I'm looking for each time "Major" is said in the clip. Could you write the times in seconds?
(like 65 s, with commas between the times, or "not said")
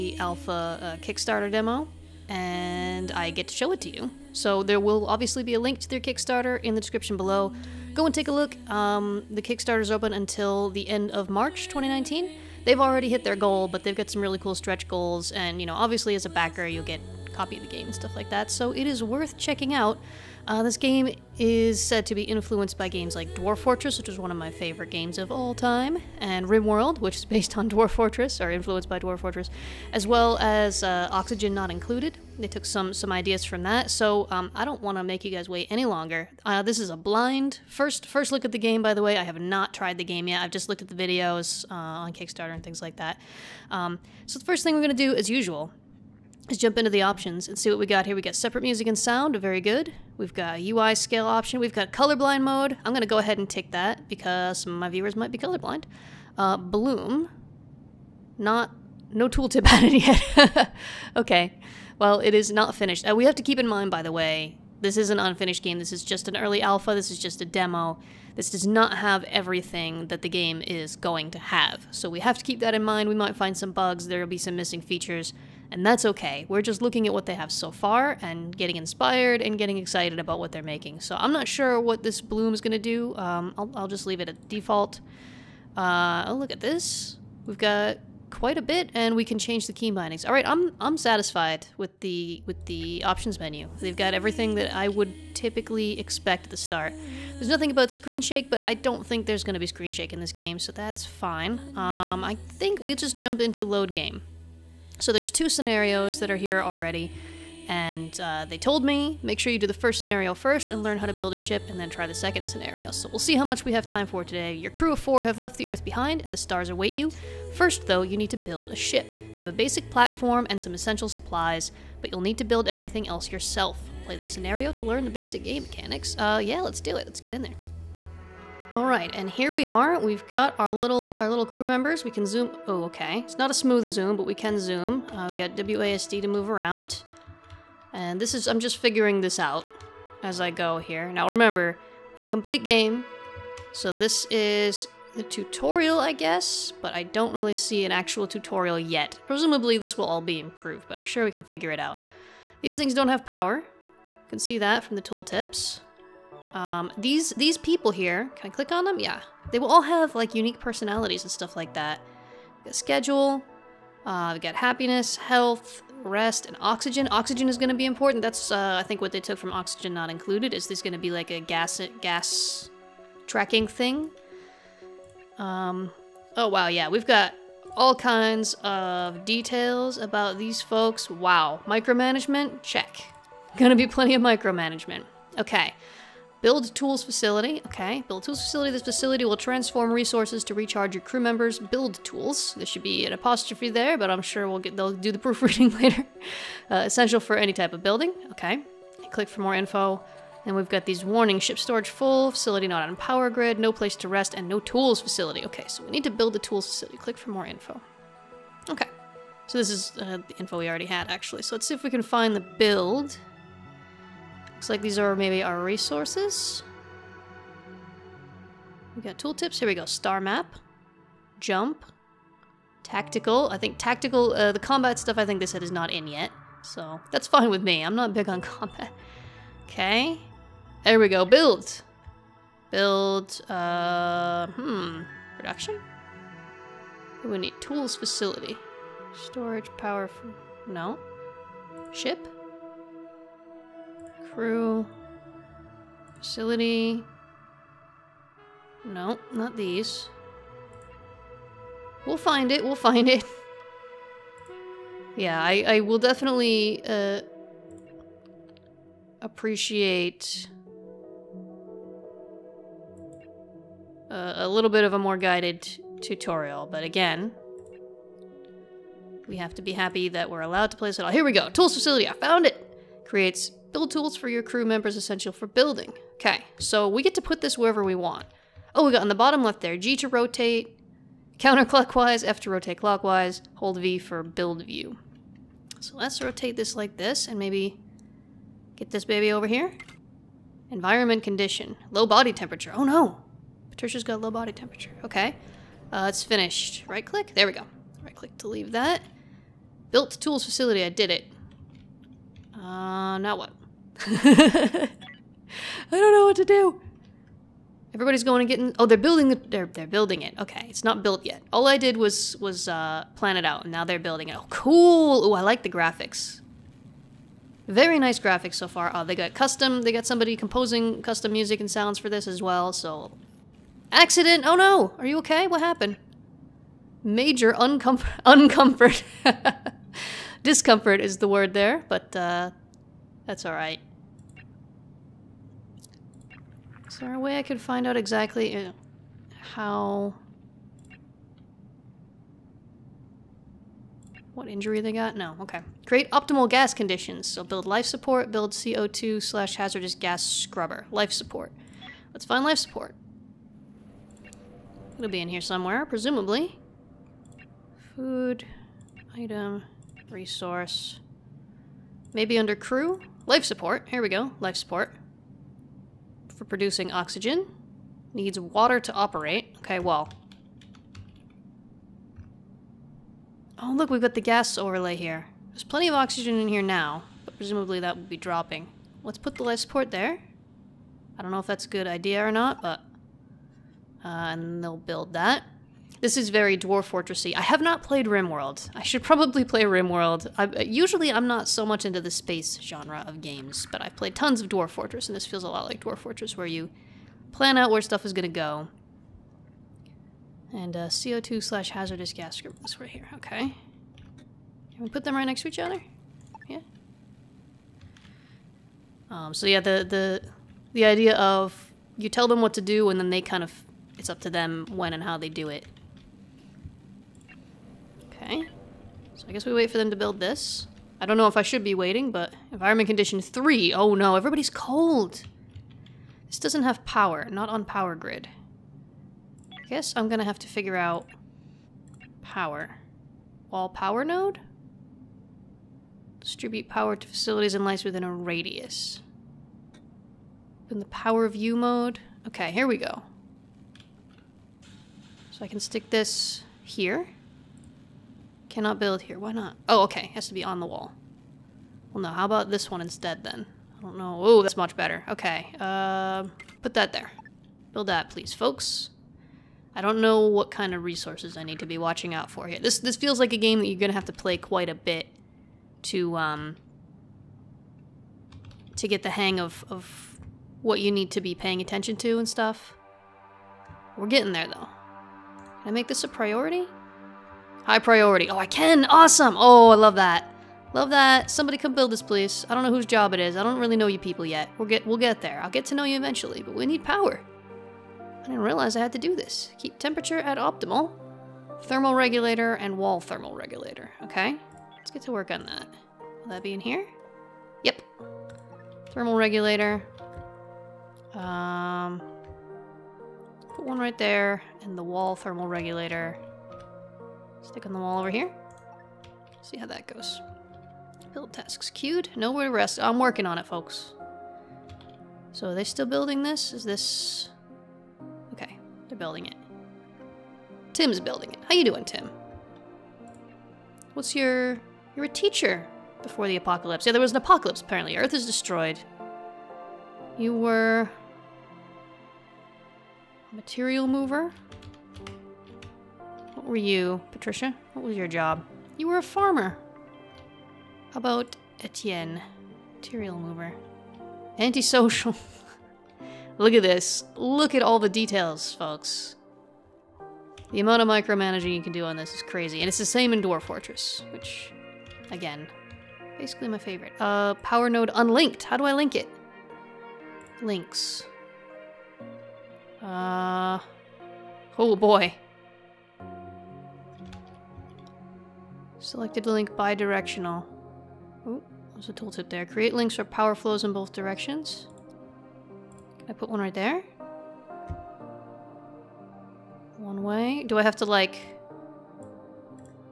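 327 s.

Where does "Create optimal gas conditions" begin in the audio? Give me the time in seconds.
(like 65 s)
345 s.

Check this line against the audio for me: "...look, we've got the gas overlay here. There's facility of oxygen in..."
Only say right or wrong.
wrong.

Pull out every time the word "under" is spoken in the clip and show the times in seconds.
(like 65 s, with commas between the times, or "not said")
362 s.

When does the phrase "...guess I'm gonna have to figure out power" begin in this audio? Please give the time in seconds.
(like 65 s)
429 s.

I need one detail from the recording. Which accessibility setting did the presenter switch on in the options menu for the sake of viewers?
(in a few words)
Colorblind mode.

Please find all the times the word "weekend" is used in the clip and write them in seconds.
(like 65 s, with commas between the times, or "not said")
not said.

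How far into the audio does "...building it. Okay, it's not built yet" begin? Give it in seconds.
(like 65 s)
309 s.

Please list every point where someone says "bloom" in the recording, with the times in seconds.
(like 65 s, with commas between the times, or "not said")
56 s, 82 s.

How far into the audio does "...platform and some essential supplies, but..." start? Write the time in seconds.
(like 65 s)
119 s.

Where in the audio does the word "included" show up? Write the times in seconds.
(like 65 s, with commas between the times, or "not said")
31 s, 170 s.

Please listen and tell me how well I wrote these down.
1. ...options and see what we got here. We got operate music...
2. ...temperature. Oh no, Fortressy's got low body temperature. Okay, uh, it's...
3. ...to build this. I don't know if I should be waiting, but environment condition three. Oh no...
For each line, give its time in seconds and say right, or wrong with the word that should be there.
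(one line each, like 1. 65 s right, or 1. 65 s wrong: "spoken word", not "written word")
1. 47 s wrong: "separate", not "operate"
2. 292 s wrong: "Patricia", not "Fortressy"
3. 419 s right.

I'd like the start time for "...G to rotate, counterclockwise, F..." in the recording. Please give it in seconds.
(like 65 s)
279 s.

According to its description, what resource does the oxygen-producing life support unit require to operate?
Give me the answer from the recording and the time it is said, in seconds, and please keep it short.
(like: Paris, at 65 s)
Water, at 368 s.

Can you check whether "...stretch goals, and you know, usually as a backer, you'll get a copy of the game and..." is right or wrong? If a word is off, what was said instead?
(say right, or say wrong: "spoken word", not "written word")
wrong: "obviously", not "usually".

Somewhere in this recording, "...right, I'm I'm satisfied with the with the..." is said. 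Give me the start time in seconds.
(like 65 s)
90 s.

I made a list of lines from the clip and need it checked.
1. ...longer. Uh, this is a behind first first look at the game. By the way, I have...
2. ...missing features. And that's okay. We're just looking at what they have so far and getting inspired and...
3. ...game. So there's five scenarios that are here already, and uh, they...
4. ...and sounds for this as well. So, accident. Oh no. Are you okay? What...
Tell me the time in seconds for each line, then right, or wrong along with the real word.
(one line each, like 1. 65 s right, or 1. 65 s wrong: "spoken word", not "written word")
1. 35 s wrong: "blind", not "behind"
2. 74 s right
3. 103 s wrong: "two", not "five"
4. 321 s right.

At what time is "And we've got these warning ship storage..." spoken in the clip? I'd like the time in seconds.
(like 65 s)
200 s.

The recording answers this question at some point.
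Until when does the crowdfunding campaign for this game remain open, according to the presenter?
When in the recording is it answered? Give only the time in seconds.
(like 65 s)
10 s.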